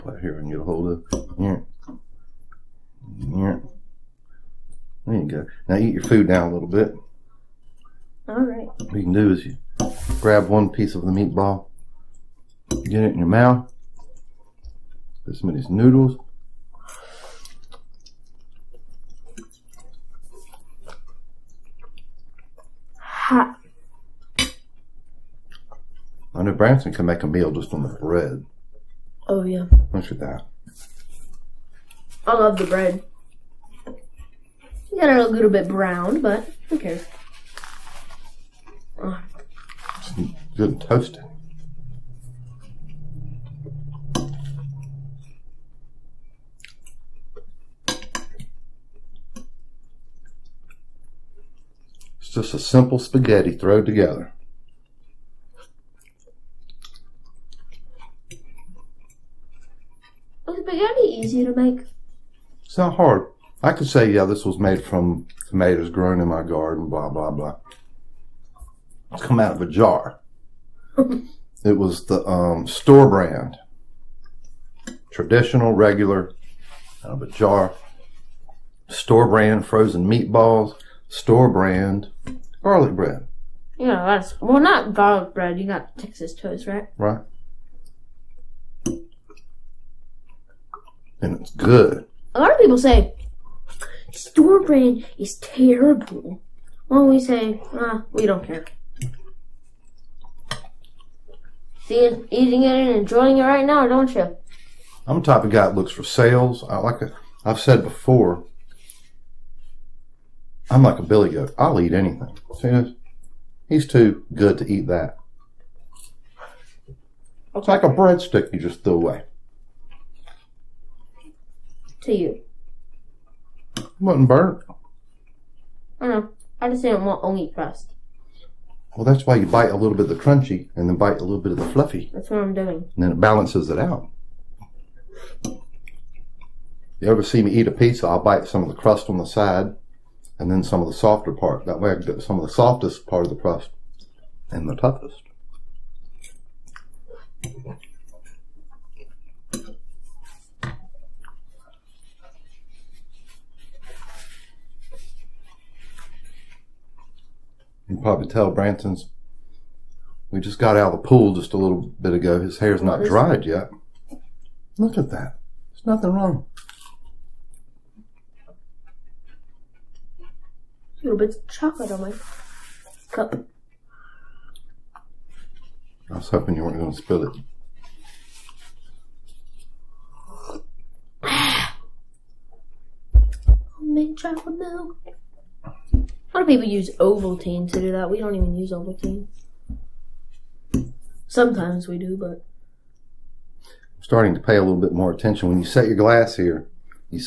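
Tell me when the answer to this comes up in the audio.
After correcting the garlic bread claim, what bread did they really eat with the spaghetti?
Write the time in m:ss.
1:25.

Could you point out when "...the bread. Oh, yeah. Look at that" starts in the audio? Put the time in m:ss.
0:27.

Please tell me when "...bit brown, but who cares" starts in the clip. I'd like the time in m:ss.
0:35.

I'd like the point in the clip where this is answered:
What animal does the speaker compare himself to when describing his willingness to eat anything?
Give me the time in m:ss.
1:51.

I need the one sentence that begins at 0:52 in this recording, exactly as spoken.
It's just a simple spaghetti thrown together.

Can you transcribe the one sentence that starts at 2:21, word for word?
That way I get some of the softest part of the crust and the toughest.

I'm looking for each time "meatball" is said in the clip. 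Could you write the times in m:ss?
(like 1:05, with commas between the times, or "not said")
0:11, 1:20.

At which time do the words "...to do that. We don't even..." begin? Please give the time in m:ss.
3:07.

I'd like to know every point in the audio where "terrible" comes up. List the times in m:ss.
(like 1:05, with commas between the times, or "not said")
1:35.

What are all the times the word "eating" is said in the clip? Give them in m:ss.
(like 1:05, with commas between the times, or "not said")
1:42.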